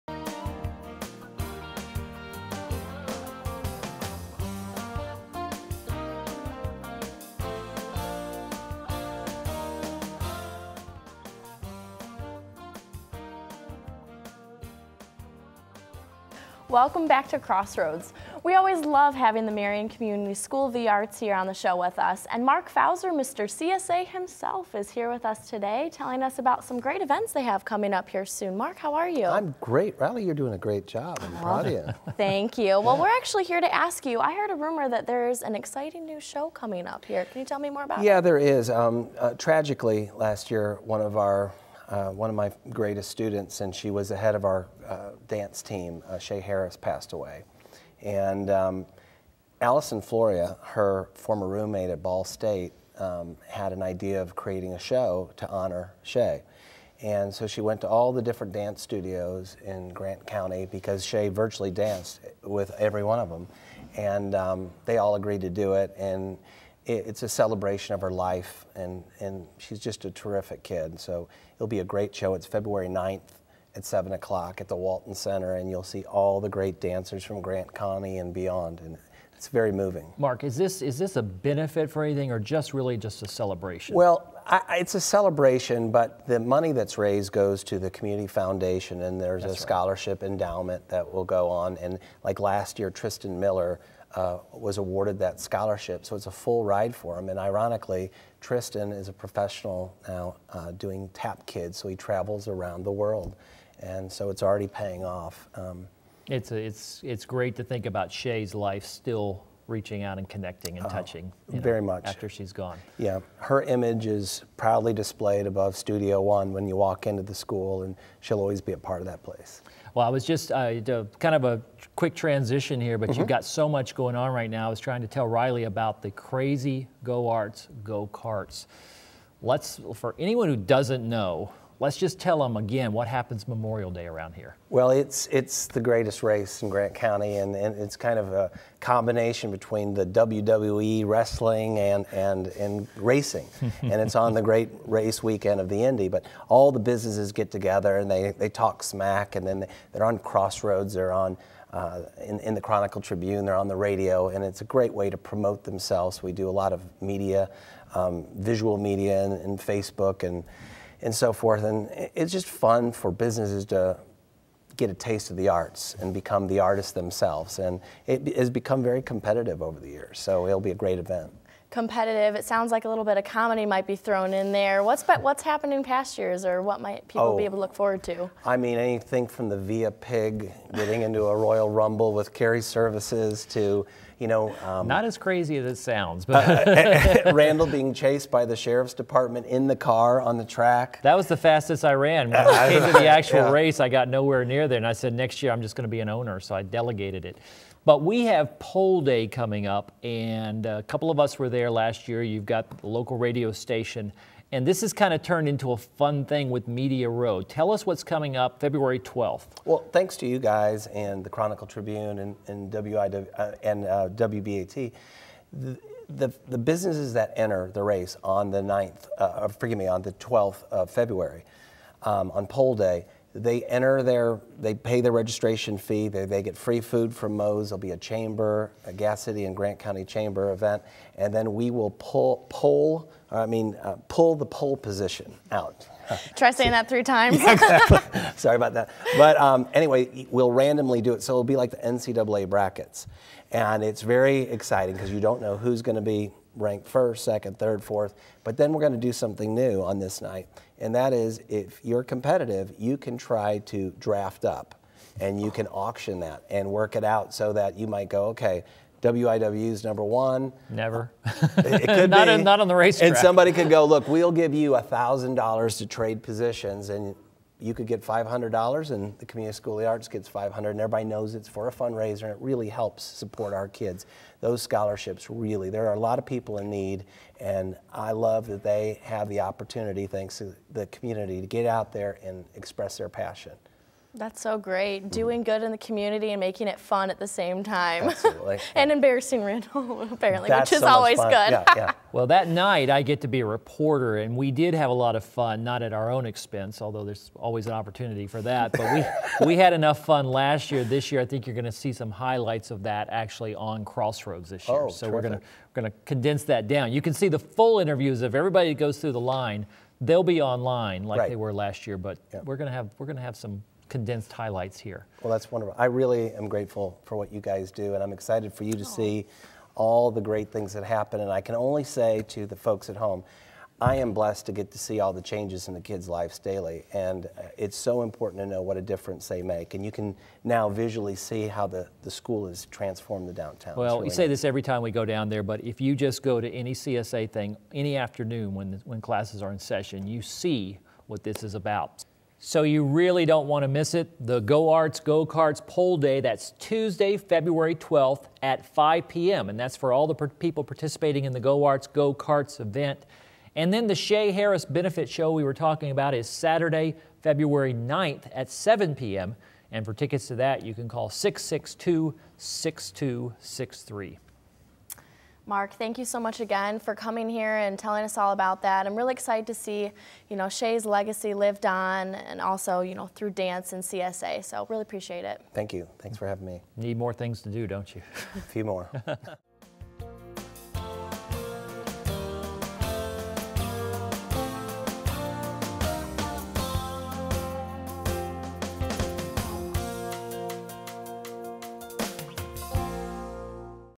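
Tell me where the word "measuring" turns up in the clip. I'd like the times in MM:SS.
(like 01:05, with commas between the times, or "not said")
not said.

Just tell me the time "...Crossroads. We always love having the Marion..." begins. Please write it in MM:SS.
00:17.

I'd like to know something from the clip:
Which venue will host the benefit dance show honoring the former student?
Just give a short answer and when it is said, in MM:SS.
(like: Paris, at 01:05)
Walton Center, at 01:14.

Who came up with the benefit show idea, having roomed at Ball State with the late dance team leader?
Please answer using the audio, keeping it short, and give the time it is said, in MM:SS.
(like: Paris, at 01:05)
Allison Floria, at 00:49.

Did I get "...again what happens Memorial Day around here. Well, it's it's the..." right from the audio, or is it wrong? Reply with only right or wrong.
right.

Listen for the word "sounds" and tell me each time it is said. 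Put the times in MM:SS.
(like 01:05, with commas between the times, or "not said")
02:52, 03:05.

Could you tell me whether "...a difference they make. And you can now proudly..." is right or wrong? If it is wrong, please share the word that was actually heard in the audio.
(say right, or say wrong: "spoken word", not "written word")
wrong: "visually", not "proudly".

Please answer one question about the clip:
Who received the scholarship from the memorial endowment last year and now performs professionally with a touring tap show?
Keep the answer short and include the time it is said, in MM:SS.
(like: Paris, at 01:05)
Tristan Miller, at 01:32.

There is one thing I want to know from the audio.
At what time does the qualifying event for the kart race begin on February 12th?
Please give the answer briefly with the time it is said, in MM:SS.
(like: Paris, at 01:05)
5 p.m., at 05:48.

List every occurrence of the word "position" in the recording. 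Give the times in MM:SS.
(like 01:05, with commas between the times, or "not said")
03:54, 04:26.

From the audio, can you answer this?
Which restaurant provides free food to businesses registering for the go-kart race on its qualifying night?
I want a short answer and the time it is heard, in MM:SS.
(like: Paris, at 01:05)
Moe's, at 03:47.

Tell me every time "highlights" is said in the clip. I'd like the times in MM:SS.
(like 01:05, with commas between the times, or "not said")
05:02, 05:14.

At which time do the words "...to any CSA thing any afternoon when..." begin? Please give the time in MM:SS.
05:36.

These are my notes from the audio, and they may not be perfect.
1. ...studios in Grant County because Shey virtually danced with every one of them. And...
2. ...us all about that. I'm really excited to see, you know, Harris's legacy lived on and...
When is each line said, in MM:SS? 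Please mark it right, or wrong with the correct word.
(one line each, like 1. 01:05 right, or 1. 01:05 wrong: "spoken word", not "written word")
1. 00:58 right
2. 06:08 wrong: "Shey", not "Harris".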